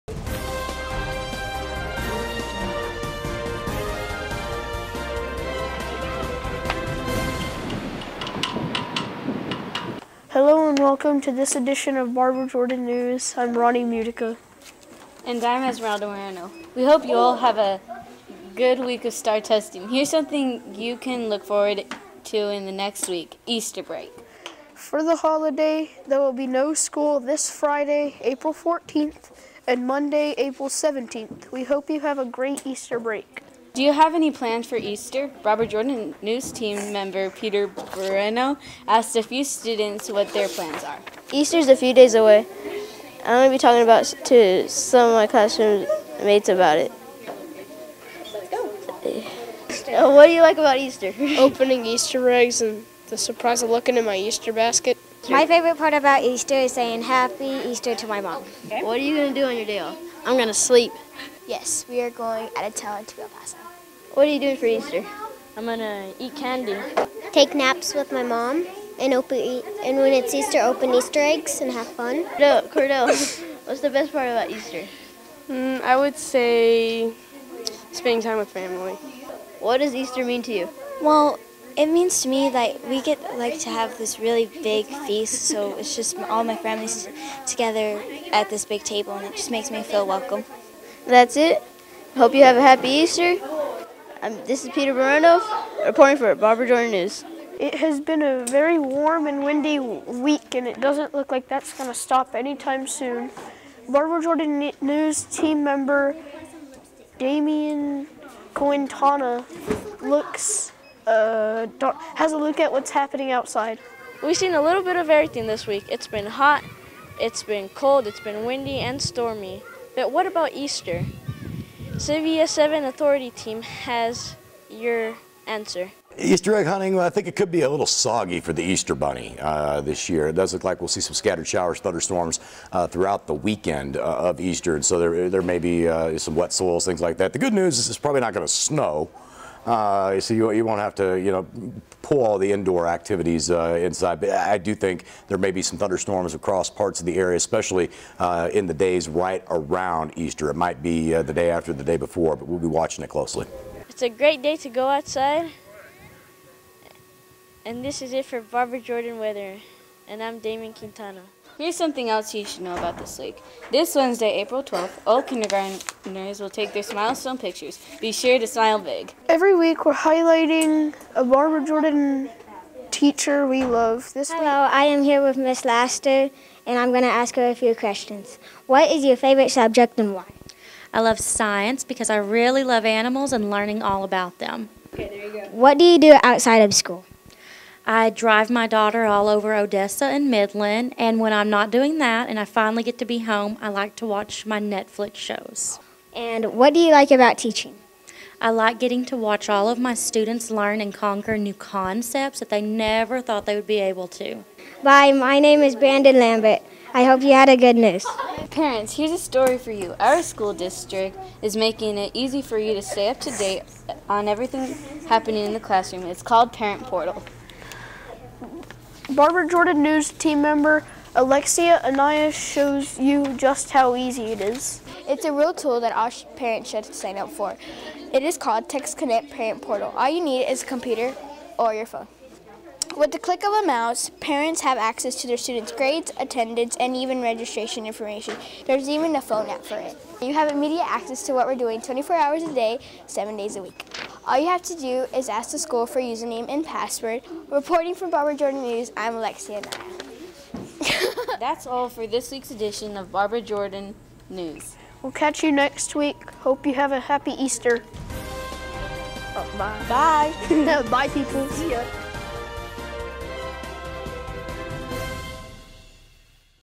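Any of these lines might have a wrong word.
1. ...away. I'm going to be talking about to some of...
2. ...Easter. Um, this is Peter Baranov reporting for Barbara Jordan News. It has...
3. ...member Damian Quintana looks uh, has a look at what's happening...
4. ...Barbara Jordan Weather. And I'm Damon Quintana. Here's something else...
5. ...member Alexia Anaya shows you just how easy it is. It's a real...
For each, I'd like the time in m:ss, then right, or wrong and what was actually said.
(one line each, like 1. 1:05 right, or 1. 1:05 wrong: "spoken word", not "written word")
1. 0:42 right
2. 1:32 right
3. 1:45 right
4. 2:38 right
5. 3:40 right.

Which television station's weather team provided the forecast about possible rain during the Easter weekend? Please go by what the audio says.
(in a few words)
CBS 7.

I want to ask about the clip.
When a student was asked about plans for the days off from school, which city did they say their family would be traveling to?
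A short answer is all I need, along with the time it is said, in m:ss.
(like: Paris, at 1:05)
El Paso, at 1:03.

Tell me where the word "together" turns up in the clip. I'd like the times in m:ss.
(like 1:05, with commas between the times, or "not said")
1:27.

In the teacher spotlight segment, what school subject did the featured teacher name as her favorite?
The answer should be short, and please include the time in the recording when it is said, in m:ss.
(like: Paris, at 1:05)
Science, at 3:01.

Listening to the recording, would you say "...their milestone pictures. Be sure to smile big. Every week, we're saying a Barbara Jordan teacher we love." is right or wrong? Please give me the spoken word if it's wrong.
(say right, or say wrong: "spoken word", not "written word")
wrong: "highlighting", not "saying".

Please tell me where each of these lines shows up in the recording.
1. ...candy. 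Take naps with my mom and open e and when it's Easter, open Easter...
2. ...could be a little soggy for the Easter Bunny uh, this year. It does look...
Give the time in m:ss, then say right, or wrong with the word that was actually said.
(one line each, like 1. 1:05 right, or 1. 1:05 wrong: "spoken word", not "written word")
1. 1:06 right
2. 2:07 right.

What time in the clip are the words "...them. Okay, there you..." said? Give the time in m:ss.
3:04.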